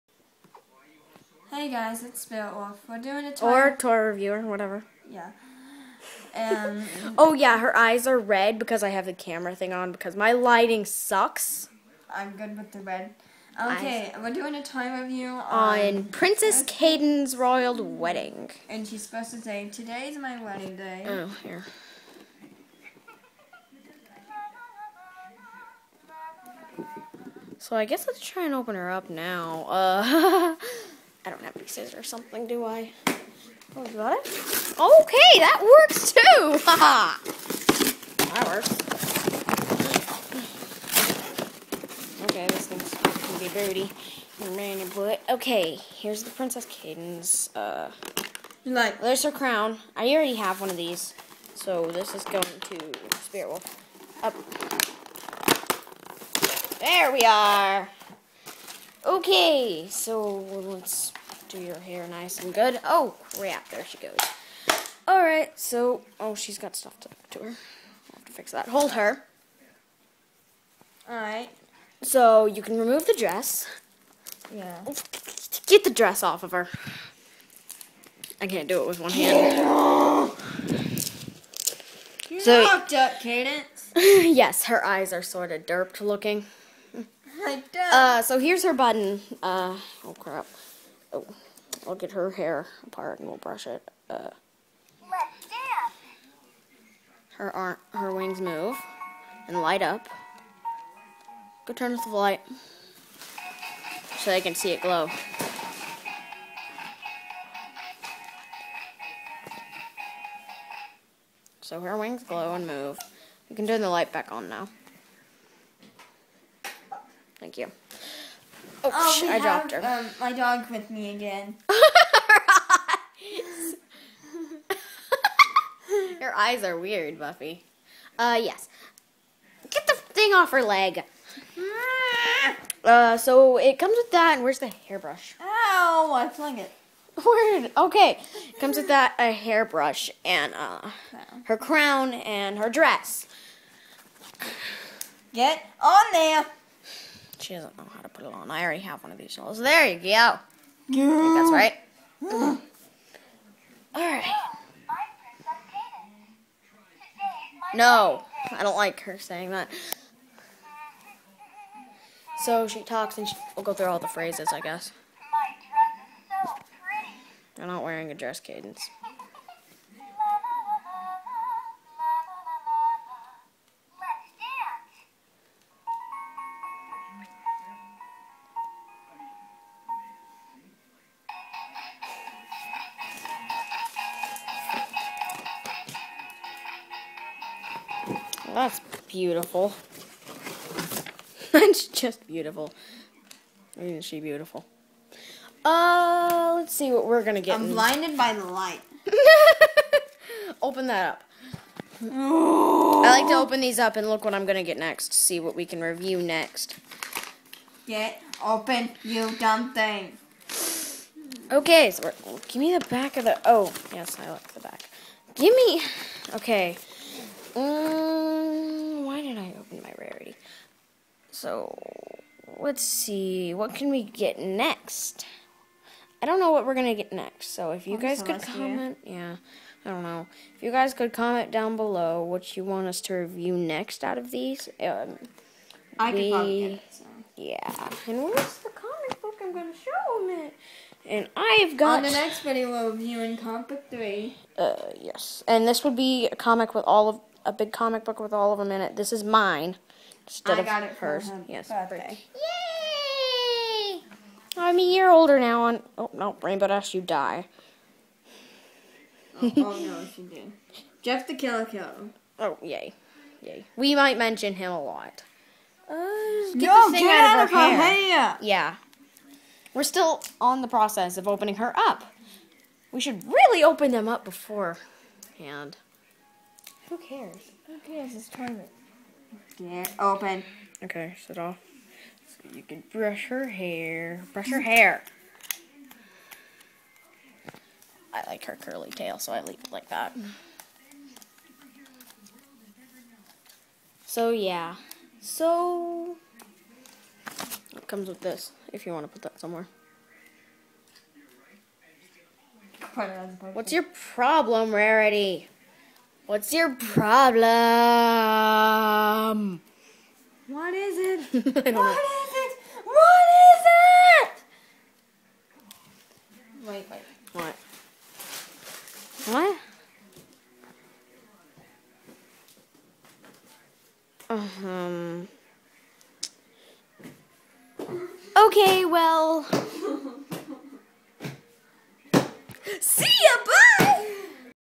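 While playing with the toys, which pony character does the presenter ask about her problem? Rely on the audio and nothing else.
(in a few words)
Rarity.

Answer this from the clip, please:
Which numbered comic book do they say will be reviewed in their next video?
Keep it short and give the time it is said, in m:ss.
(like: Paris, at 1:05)
comic book 3, at 4:03.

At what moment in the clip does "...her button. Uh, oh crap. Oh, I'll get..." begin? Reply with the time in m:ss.
1:28.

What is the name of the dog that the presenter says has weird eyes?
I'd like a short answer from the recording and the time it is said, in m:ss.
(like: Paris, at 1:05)
Buffy, at 2:07.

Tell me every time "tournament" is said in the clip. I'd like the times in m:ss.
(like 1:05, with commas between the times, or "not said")
4:38.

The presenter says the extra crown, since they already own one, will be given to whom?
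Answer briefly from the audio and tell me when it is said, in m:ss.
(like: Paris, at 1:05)
Spirit Wolf, at 0:53.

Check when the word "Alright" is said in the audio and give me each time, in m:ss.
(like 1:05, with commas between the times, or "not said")
1:05, 1:11.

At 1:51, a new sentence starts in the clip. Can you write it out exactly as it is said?
So her wings glow and move.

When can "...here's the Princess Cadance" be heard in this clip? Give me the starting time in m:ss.
0:45.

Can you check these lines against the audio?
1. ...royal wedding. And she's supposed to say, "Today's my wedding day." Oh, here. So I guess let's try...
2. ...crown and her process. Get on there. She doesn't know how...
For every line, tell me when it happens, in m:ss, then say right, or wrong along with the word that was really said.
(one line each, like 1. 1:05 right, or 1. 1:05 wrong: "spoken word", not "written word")
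1. 0:17 right
2. 2:21 wrong: "dress", not "process".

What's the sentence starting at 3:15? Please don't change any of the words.
Uh, let's see what we're gonna get.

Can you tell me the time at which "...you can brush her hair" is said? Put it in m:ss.
4:42.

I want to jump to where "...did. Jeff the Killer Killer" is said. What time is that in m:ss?
4:20.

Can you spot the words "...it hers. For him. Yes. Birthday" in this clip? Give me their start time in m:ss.
4:10.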